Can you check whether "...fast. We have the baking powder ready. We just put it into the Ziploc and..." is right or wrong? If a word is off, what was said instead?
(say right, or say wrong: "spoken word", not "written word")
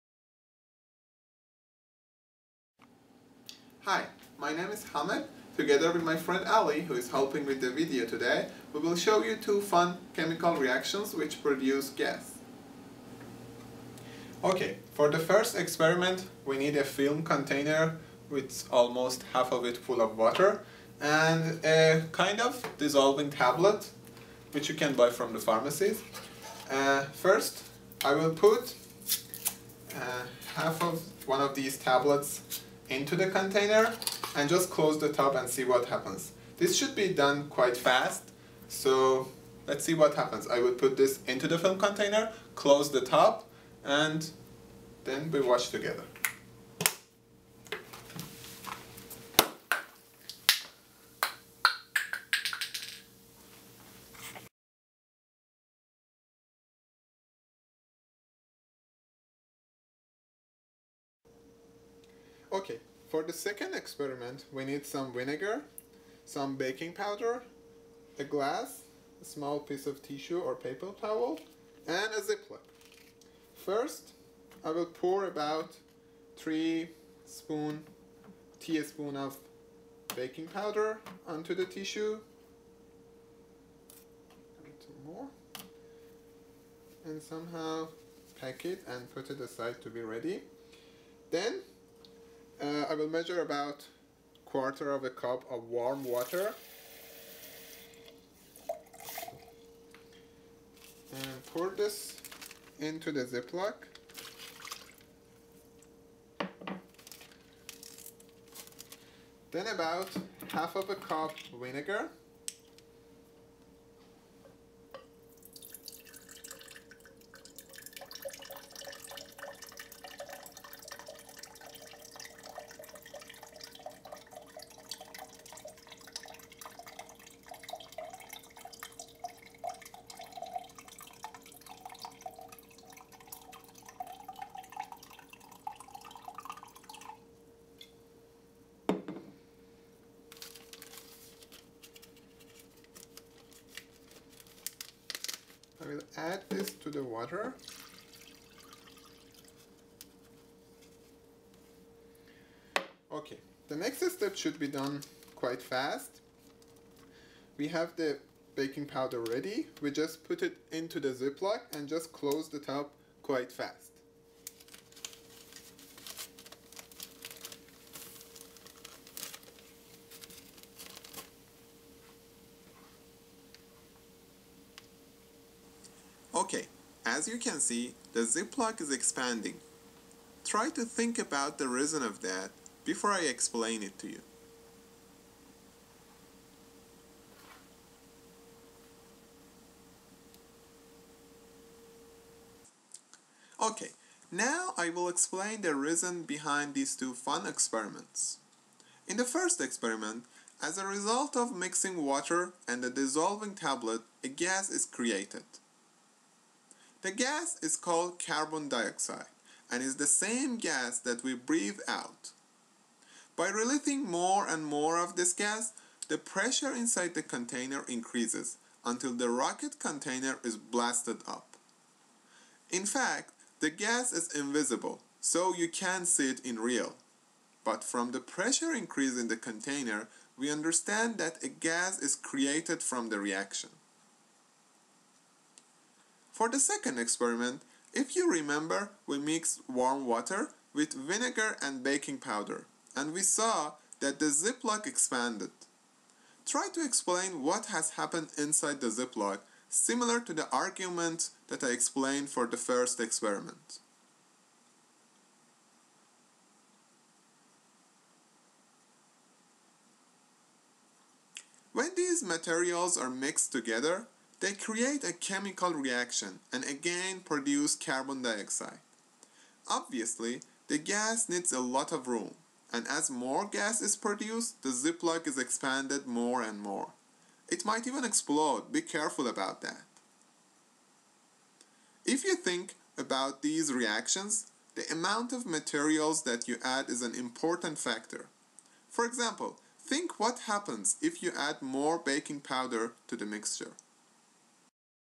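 right.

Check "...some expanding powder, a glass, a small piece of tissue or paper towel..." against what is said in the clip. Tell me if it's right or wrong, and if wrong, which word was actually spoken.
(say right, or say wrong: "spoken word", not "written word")
wrong: "baking", not "expanding".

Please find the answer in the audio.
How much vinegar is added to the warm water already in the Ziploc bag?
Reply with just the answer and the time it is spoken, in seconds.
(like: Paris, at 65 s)
half of a cup, at 110 s.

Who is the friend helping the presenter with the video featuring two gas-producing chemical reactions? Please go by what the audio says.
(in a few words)
Ali.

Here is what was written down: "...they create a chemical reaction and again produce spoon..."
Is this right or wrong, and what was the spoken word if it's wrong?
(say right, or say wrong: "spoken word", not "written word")
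wrong: "carbon", not "spoon".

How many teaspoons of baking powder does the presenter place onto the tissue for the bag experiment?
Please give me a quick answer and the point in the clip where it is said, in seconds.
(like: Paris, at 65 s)
3, at 76 s.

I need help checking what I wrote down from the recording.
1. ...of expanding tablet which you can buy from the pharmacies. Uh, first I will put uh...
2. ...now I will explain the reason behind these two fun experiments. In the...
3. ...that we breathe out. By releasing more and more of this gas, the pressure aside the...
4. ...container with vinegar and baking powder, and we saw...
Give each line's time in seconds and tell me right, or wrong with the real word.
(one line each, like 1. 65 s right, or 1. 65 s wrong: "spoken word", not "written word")
1. 22 s wrong: "dissolving", not "expanding"
2. 194 s right
3. 210 s wrong: "inside", not "aside"
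4. 240 s wrong: "water", not "container".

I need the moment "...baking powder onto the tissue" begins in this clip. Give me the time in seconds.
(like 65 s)
80 s.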